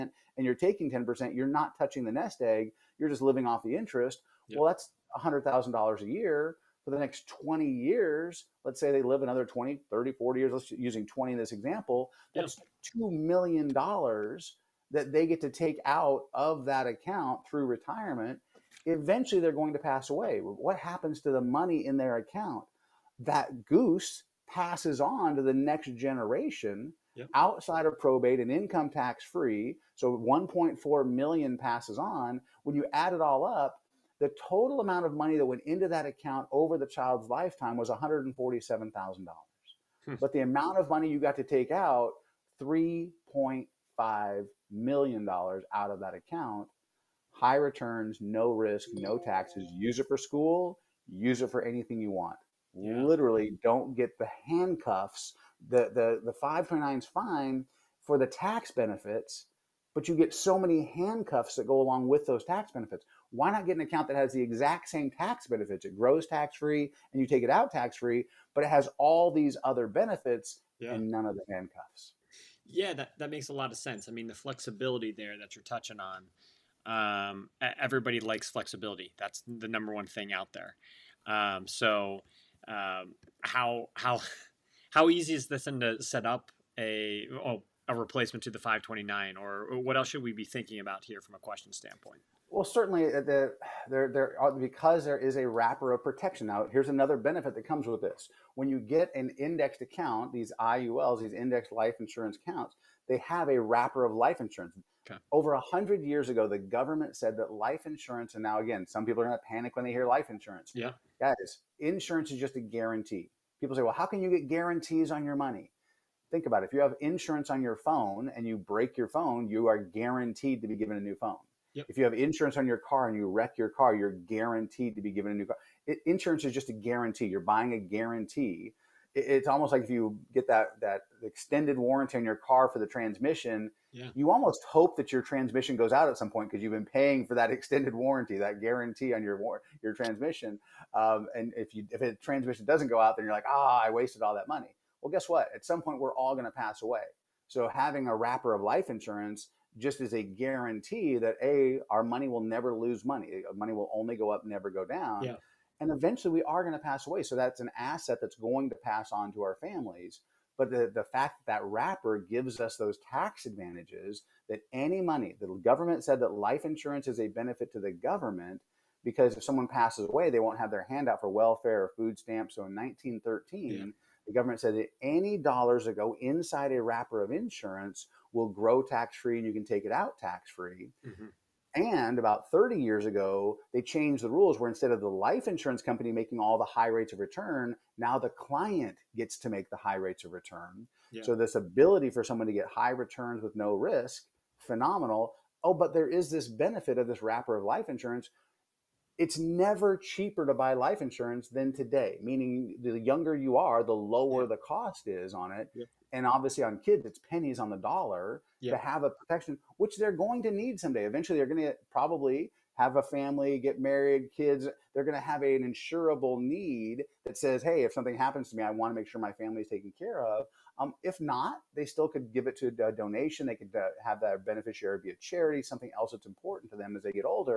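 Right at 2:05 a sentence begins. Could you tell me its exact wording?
It, insurance is just a guarantee.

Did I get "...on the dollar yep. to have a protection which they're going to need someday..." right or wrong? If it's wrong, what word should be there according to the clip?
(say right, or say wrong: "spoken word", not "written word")
right.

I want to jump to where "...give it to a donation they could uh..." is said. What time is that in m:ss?
3:42.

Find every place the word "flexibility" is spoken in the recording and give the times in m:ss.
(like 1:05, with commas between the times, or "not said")
1:14, 1:18.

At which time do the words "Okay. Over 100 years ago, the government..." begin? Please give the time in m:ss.
1:45.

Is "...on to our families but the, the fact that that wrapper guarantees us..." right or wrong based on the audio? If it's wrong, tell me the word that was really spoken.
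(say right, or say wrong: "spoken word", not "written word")
wrong: "gives", not "guarantees".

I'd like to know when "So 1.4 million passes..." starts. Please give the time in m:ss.
0:29.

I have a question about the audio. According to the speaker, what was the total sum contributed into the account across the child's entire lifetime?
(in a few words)
$147,000.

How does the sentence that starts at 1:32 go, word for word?
Well, certainly, uh, the, there, there are, uh, because there is a wrapper of protection.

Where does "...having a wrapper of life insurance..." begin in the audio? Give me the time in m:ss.
2:27.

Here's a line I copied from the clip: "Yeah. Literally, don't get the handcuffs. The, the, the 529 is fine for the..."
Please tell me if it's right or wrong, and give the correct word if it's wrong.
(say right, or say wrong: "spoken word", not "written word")
right.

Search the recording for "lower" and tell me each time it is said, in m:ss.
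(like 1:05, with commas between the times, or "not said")
3:23.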